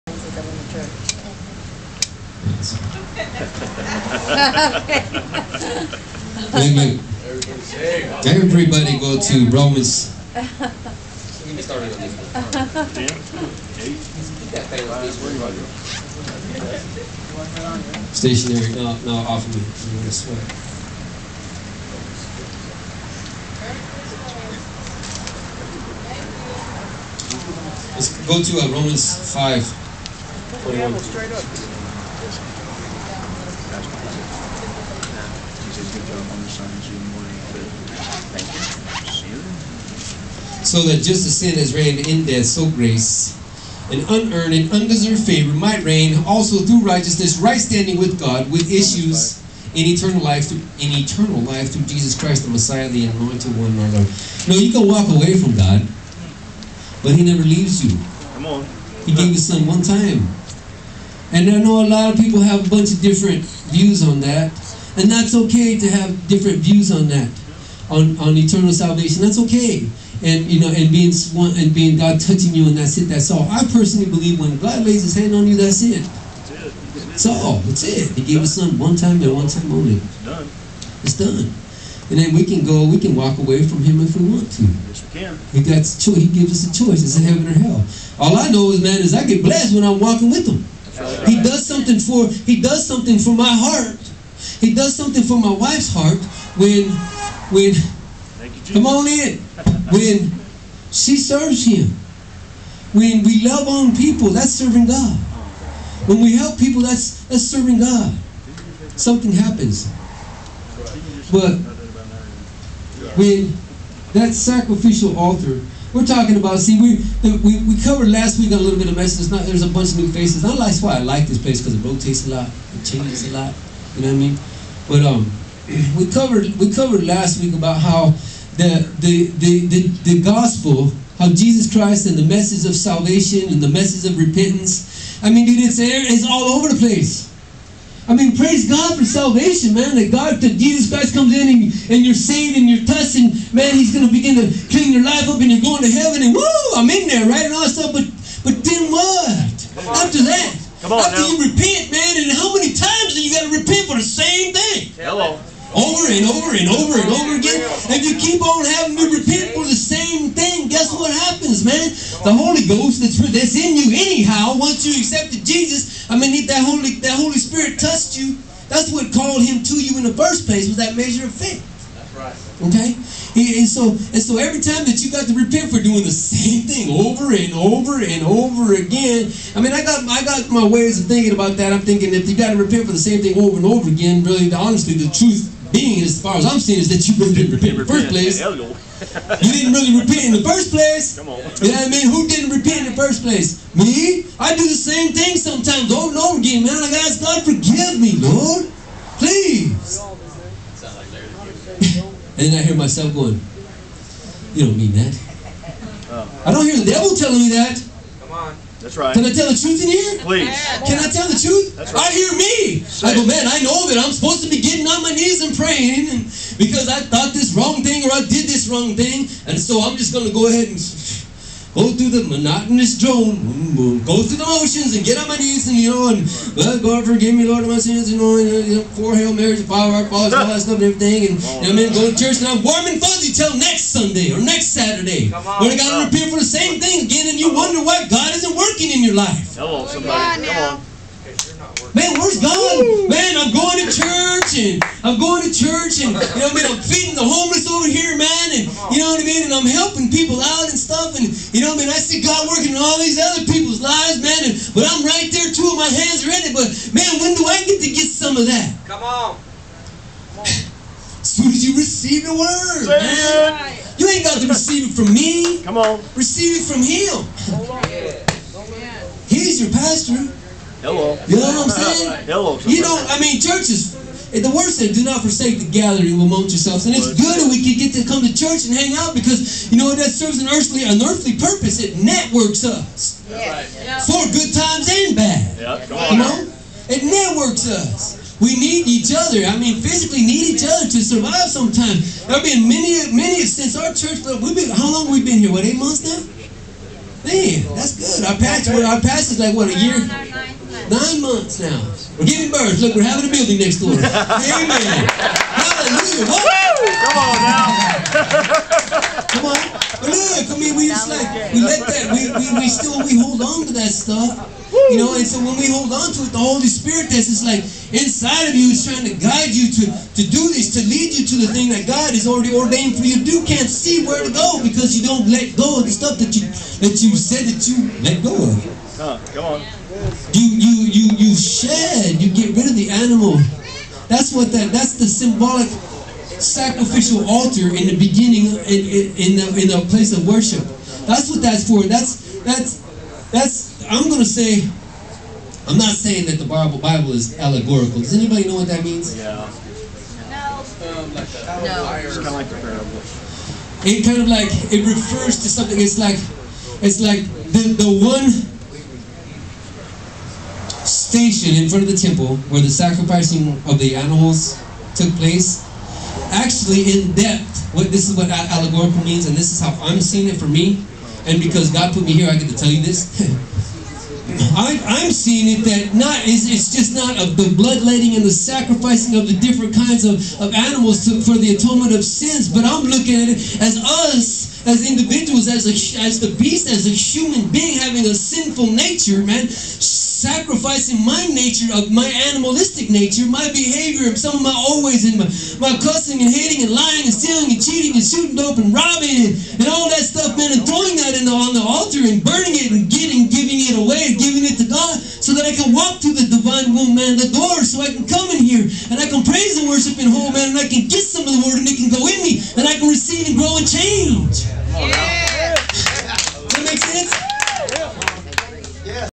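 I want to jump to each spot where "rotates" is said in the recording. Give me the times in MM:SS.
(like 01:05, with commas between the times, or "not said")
02:01.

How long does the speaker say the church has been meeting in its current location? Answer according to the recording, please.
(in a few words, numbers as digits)
8 months.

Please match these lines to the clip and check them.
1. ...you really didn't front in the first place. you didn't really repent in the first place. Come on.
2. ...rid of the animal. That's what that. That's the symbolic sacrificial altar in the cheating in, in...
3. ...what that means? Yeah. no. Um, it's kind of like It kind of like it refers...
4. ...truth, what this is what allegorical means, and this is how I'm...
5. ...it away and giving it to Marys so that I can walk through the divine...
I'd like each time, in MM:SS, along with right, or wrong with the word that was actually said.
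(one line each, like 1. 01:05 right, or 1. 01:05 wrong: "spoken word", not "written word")
1. 03:07 wrong: "repent", not "front"
2. 05:32 wrong: "beginning", not "cheating"
3. 05:48 right
4. 06:07 wrong: "depth", not "truth"
5. 06:43 wrong: "God", not "Marys".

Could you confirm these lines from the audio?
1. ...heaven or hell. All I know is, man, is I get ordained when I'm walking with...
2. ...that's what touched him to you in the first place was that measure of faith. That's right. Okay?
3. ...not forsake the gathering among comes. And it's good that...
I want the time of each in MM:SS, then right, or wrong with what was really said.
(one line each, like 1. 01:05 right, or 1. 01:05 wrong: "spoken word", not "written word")
1. 01:27 wrong: "blessed", not "ordained"
2. 02:48 wrong: "called", not "touched"
3. 04:35 wrong: "yourselves", not "comes".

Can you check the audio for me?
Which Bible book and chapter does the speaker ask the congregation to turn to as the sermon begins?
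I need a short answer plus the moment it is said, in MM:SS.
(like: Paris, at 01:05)
Romans 5, at 00:28.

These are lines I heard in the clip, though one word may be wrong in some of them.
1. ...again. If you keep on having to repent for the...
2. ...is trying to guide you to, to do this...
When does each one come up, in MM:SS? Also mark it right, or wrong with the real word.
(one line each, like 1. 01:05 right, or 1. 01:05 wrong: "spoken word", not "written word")
1. 02:37 right
2. 05:18 right.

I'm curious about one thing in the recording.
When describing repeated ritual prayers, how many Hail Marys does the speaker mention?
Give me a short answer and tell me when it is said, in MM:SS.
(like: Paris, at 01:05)
4, at 03:48.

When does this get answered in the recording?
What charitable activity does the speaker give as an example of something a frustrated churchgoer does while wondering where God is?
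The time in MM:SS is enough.
04:06.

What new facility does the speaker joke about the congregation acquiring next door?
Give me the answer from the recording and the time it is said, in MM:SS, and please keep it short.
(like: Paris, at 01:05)
A building, at 05:03.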